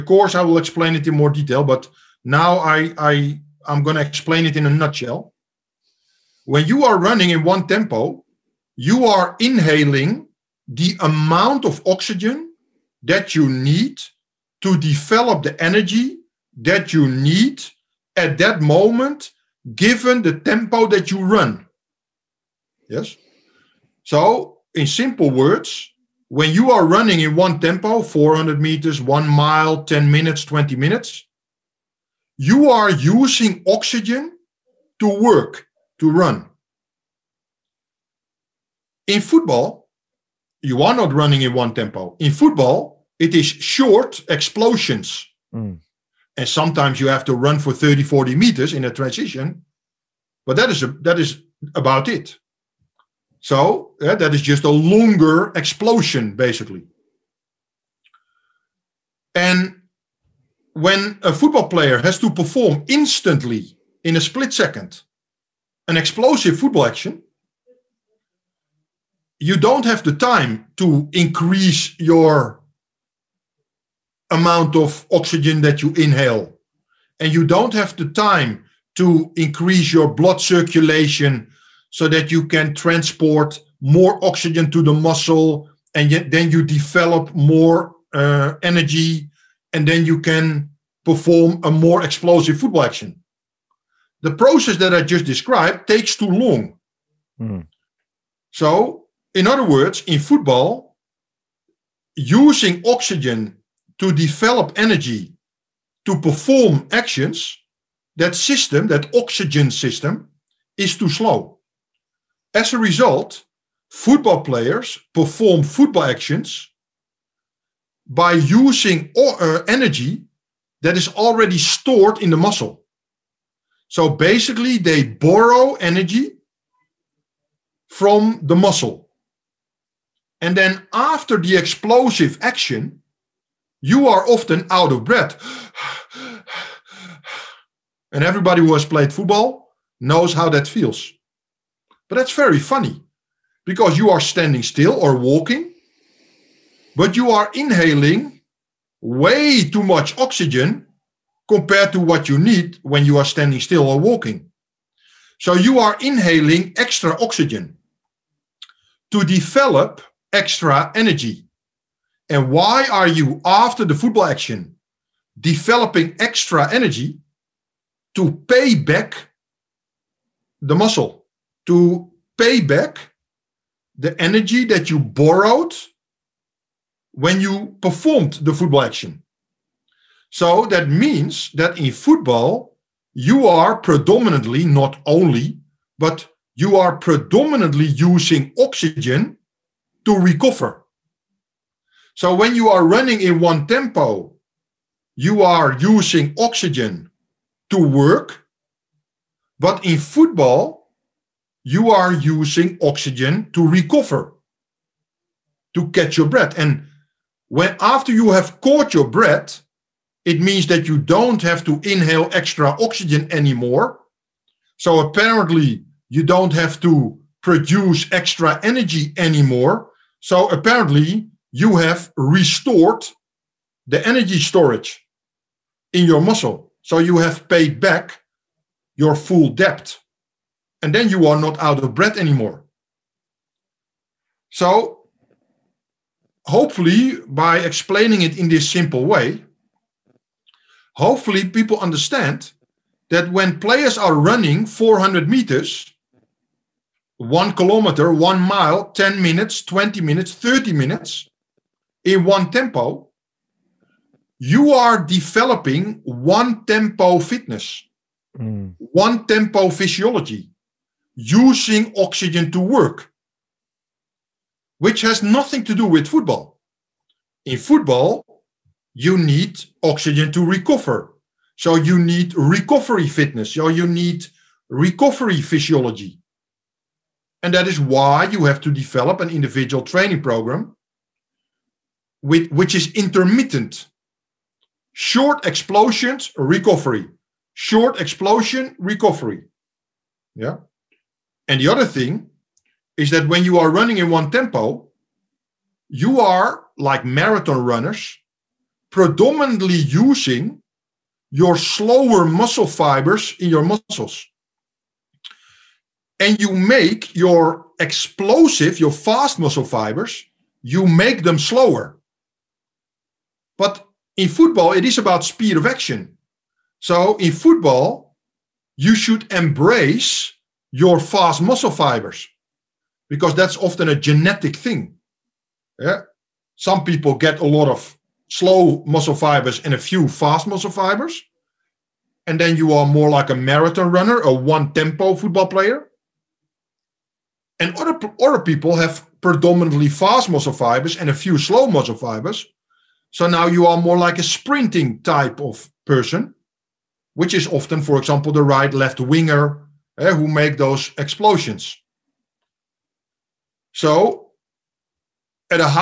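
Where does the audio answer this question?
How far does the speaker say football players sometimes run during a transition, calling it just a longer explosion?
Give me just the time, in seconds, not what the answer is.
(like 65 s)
47 s.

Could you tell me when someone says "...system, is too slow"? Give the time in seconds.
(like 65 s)
109 s.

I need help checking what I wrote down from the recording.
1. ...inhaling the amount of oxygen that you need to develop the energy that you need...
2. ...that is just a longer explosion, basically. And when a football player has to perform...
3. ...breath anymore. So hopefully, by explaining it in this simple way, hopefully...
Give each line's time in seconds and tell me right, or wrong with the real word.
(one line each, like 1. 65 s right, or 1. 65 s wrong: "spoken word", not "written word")
1. 9 s right
2. 54 s right
3. 231 s right.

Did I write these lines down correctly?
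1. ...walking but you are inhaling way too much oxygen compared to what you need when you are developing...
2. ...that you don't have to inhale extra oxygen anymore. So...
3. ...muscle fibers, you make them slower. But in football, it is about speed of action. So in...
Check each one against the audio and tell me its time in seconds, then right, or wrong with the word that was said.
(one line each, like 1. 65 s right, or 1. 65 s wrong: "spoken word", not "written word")
1. 145 s wrong: "standing", not "developing"
2. 210 s right
3. 309 s right.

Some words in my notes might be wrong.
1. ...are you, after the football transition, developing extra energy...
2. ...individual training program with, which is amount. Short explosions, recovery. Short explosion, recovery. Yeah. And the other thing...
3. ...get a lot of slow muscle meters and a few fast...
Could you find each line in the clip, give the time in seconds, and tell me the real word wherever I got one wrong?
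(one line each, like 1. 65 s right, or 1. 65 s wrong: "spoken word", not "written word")
1. 162 s wrong: "action", not "transition"
2. 279 s wrong: "intermittent", not "amount"
3. 327 s wrong: "fibers", not "meters".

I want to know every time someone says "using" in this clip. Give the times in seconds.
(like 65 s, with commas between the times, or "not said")
32 s, 102 s, 118 s, 187 s, 195 s, 202 s, 261 s, 299 s.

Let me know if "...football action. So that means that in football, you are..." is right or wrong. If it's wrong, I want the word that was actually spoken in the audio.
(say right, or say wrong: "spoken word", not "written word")
right.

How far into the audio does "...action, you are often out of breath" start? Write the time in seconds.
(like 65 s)
132 s.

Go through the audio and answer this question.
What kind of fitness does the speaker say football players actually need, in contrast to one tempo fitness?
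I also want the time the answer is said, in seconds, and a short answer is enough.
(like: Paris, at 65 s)
recovery fitness, at 272 s.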